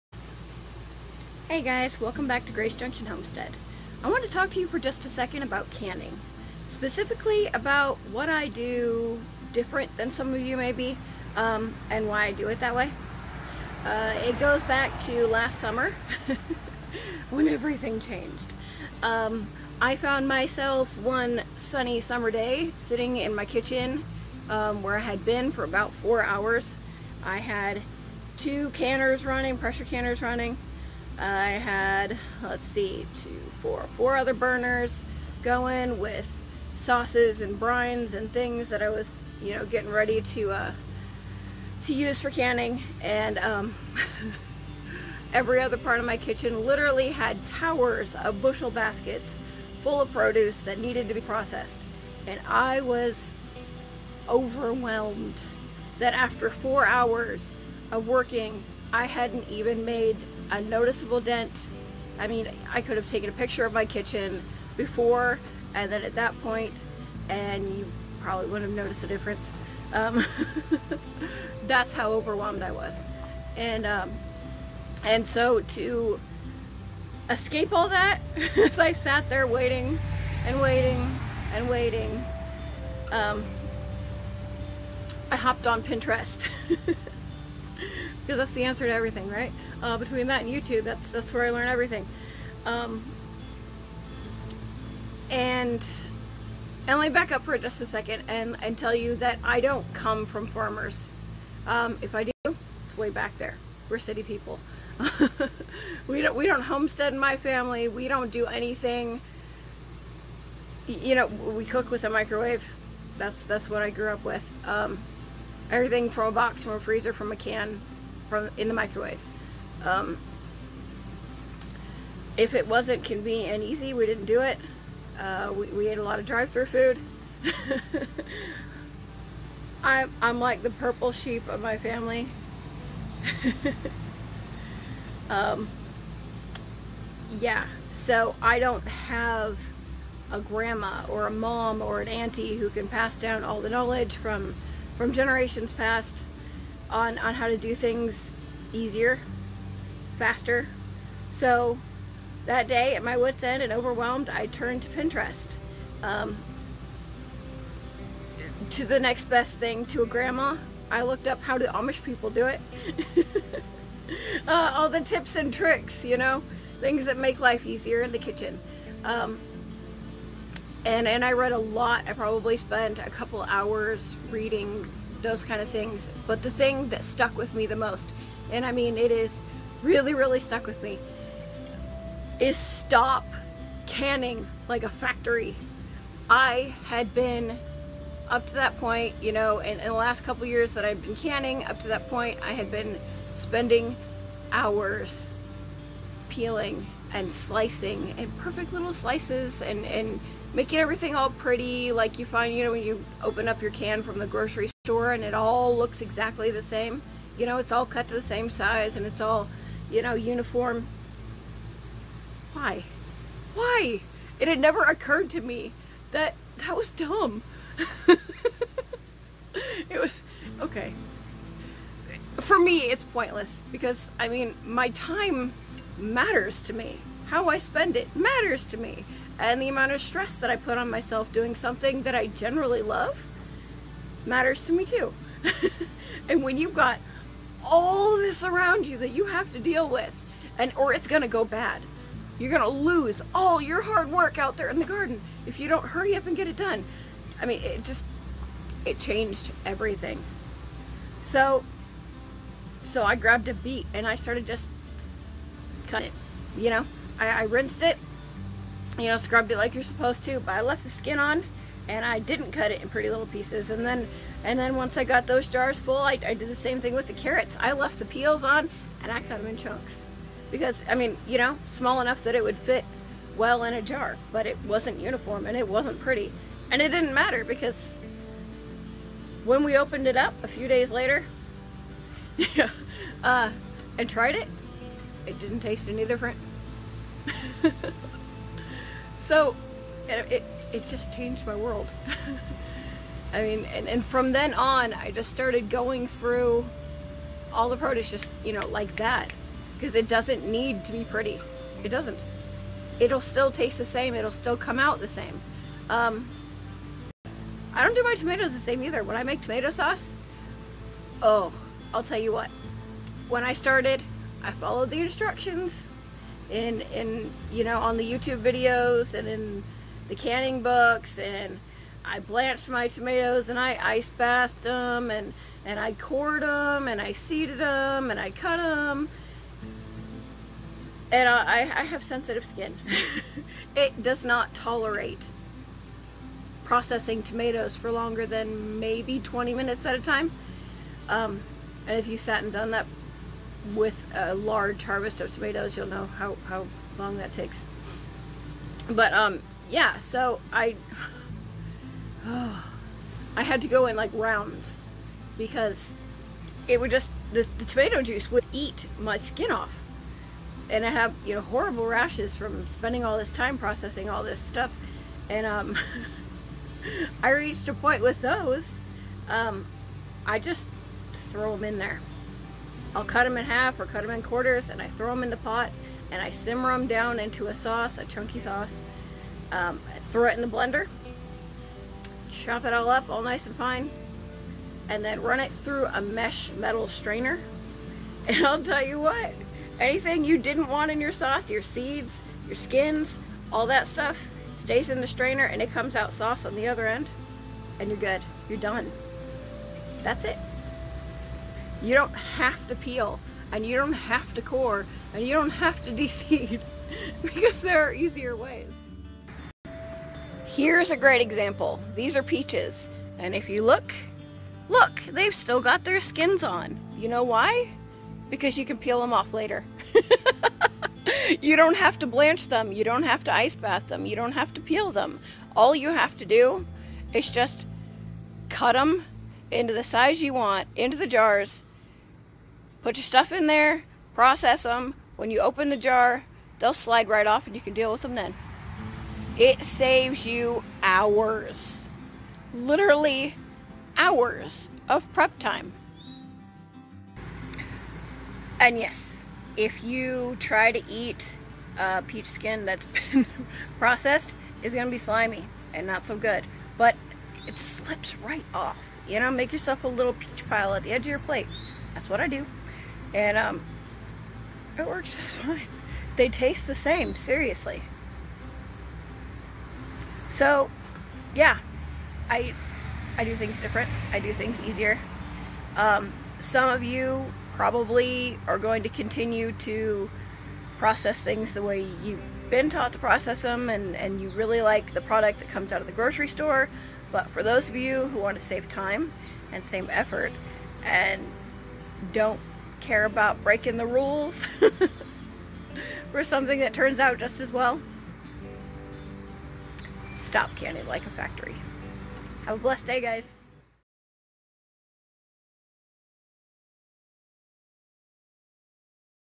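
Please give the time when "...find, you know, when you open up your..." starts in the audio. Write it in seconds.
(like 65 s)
202 s.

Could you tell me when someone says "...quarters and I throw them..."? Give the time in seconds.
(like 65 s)
374 s.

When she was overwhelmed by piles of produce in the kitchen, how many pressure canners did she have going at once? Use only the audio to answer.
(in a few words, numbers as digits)
2.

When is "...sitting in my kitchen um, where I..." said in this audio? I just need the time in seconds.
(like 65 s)
22 s.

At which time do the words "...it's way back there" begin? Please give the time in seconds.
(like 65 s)
102 s.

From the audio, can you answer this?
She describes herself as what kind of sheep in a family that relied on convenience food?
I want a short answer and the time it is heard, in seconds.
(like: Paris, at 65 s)
purple sheep, at 130 s.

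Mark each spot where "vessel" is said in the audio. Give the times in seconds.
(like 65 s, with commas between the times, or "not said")
not said.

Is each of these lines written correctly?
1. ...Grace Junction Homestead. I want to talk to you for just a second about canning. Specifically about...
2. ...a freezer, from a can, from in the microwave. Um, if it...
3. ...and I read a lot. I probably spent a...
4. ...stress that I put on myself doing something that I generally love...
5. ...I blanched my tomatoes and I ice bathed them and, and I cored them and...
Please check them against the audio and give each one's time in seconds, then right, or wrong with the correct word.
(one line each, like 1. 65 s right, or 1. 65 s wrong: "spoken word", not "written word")
1. 2 s right
2. 116 s right
3. 171 s right
4. 230 s right
5. 322 s right.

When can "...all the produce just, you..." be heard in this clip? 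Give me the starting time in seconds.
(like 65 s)
297 s.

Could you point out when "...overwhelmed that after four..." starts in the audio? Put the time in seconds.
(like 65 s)
54 s.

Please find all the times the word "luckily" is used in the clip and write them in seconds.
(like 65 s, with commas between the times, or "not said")
not said.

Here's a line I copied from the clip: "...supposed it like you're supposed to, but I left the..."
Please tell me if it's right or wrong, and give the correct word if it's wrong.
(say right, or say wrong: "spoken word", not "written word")
wrong: "scrubbed", not "supposed".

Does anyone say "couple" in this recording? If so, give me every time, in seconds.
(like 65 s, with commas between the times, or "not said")
173 s, 190 s.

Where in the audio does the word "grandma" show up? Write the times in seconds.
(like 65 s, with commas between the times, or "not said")
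140 s, 160 s.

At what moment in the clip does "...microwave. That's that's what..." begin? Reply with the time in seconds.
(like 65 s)
112 s.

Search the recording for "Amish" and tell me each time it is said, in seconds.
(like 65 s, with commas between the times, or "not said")
161 s.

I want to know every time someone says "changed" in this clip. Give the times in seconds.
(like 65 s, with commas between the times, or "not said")
17 s, 248 s, 291 s.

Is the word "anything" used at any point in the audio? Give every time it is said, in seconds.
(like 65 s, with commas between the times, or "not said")
108 s, 389 s.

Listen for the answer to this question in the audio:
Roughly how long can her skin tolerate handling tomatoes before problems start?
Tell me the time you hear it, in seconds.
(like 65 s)
339 s.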